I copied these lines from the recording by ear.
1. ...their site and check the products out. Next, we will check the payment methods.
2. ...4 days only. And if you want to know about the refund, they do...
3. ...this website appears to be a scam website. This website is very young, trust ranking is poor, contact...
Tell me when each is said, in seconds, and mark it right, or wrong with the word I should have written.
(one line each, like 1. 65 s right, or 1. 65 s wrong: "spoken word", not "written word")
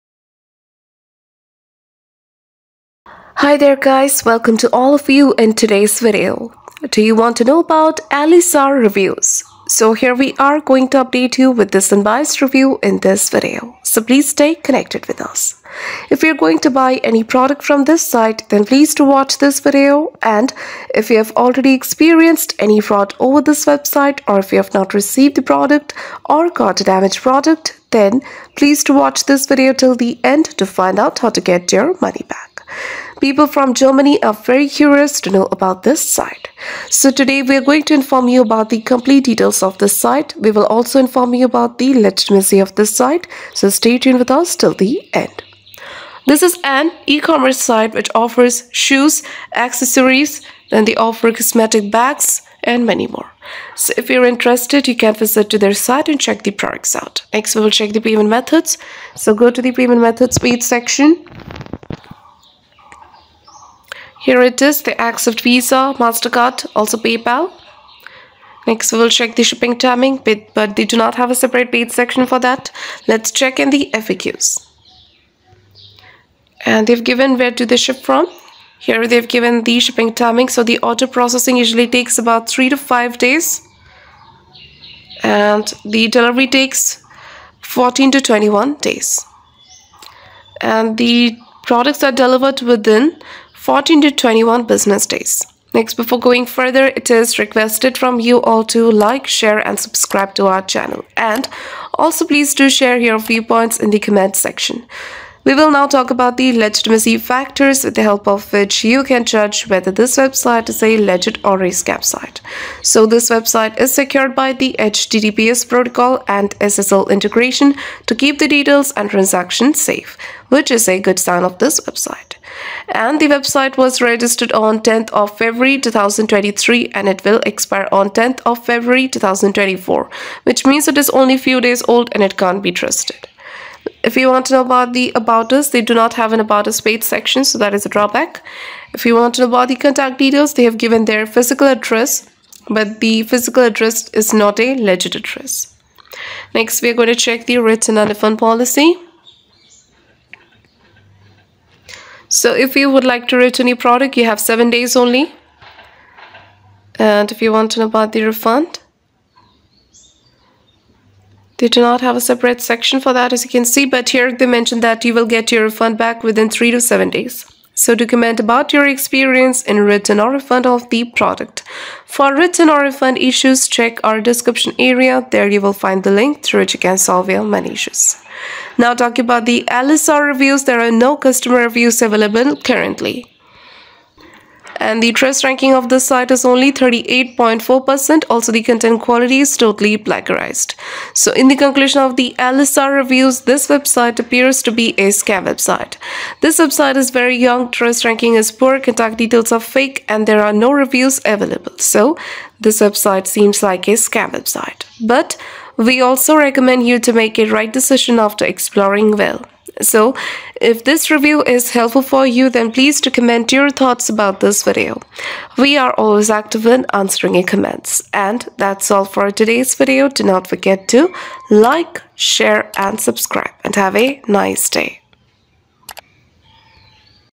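1. 55 s right
2. 154 s wrong: "7", not "4"
3. 193 s right.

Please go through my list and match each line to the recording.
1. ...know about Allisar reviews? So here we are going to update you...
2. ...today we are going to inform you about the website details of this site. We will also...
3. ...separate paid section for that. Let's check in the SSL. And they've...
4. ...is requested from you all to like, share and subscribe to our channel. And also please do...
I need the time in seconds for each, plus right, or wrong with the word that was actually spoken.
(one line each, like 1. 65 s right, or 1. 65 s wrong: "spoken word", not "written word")
1. 7 s right
2. 37 s wrong: "complete", not "website"
3. 71 s wrong: "FAQs", not "SSL"
4. 97 s right.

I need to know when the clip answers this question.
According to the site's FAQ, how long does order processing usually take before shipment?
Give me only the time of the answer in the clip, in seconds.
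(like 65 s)
82 s.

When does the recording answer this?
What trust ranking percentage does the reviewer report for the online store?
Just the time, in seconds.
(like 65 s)
186 s.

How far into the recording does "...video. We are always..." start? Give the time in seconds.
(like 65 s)
214 s.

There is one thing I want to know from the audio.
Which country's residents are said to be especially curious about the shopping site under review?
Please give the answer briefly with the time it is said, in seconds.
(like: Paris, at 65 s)
Germany, at 33 s.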